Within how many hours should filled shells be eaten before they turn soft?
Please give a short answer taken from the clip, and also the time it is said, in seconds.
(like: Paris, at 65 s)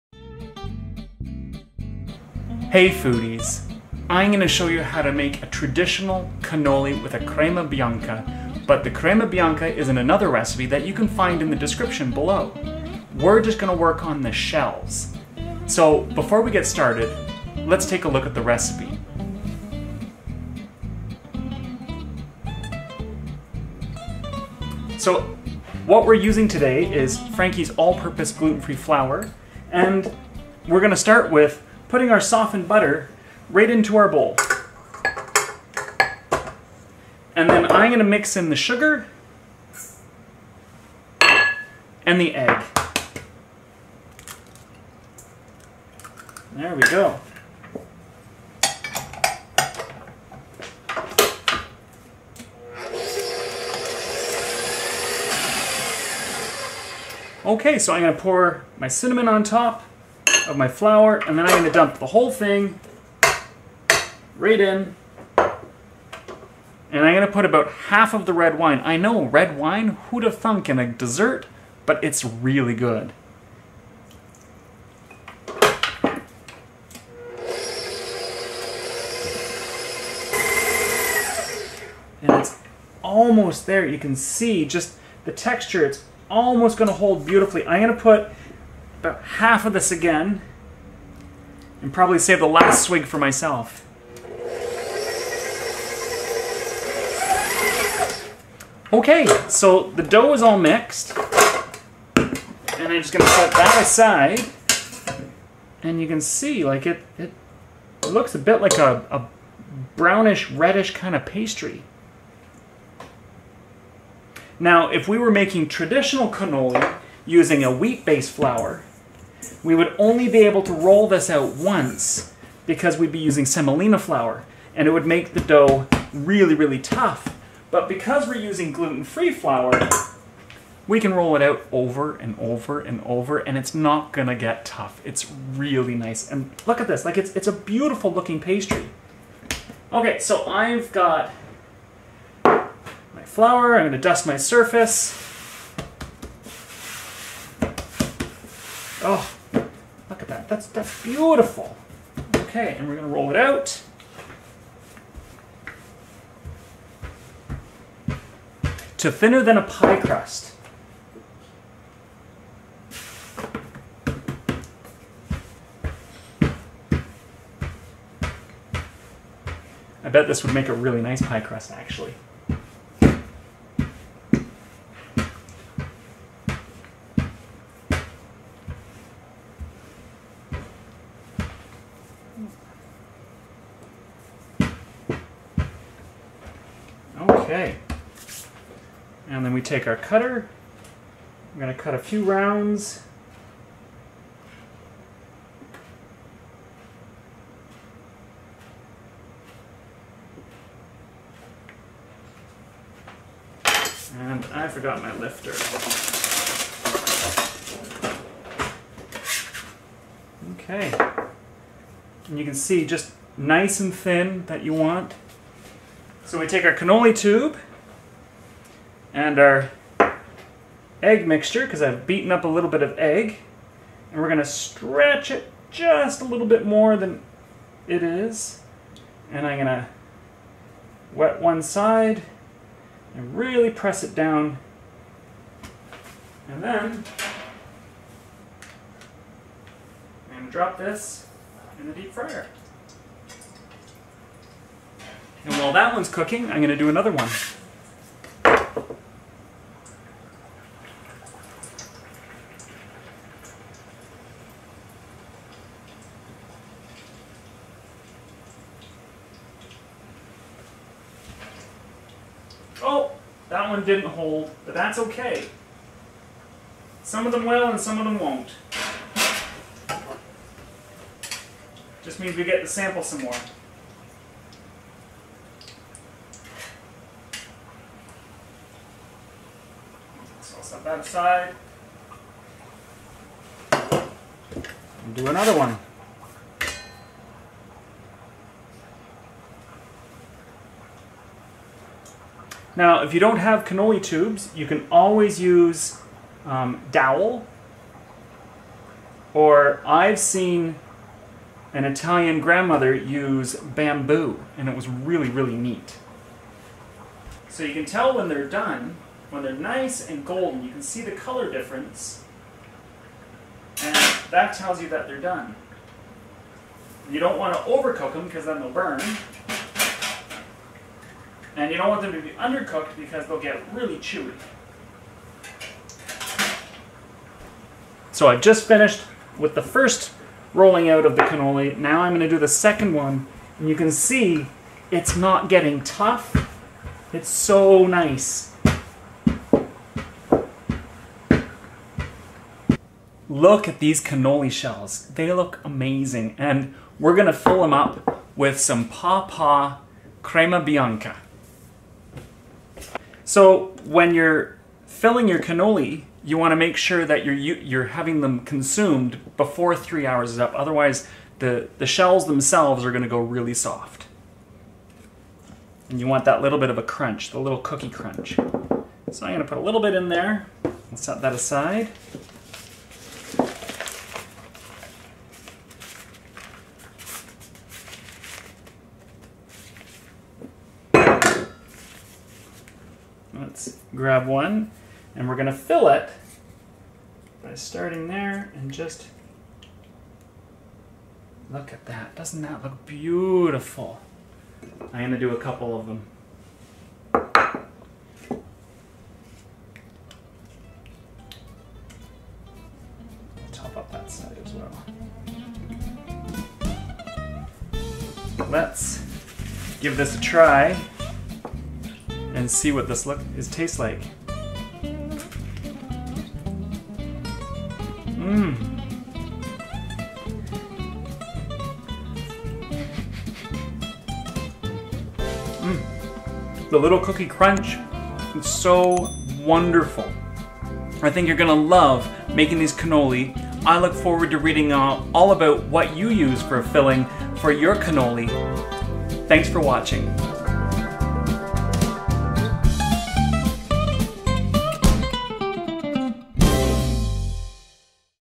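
3, at 359 s.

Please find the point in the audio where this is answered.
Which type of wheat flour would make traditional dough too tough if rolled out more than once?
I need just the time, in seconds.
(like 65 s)
123 s.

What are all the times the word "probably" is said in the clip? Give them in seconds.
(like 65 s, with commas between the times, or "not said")
91 s.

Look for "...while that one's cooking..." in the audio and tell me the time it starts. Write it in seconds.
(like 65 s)
245 s.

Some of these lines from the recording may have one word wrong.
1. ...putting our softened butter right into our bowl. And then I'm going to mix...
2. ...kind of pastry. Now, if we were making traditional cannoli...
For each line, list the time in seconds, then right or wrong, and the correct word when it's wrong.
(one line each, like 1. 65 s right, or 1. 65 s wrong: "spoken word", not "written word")
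1. 31 s right
2. 110 s right.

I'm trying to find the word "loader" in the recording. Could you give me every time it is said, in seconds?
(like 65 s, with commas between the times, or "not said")
not said.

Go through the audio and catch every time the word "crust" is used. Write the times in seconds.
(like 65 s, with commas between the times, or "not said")
159 s, 171 s.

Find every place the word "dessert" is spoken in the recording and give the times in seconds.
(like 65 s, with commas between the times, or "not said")
70 s.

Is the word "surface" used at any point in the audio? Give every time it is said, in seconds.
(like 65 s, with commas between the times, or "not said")
144 s.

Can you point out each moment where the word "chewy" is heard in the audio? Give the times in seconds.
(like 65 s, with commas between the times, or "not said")
323 s.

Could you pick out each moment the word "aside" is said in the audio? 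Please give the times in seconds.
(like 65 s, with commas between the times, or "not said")
103 s, 280 s, 371 s.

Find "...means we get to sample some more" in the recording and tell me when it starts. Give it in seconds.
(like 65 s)
272 s.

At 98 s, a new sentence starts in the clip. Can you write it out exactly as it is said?
Okay, so the dough is all mixed.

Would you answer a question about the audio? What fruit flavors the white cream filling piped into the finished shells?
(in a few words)
Pawpaw.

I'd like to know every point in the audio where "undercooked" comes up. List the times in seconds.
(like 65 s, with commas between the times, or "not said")
322 s.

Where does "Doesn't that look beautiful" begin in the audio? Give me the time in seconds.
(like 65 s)
392 s.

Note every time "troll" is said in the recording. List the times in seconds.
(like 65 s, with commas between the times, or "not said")
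not said.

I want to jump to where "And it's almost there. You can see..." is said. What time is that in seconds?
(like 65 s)
82 s.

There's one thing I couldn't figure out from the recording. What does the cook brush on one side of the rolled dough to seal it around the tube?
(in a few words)
Egg mixture.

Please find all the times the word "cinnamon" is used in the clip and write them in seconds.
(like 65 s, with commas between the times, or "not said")
58 s.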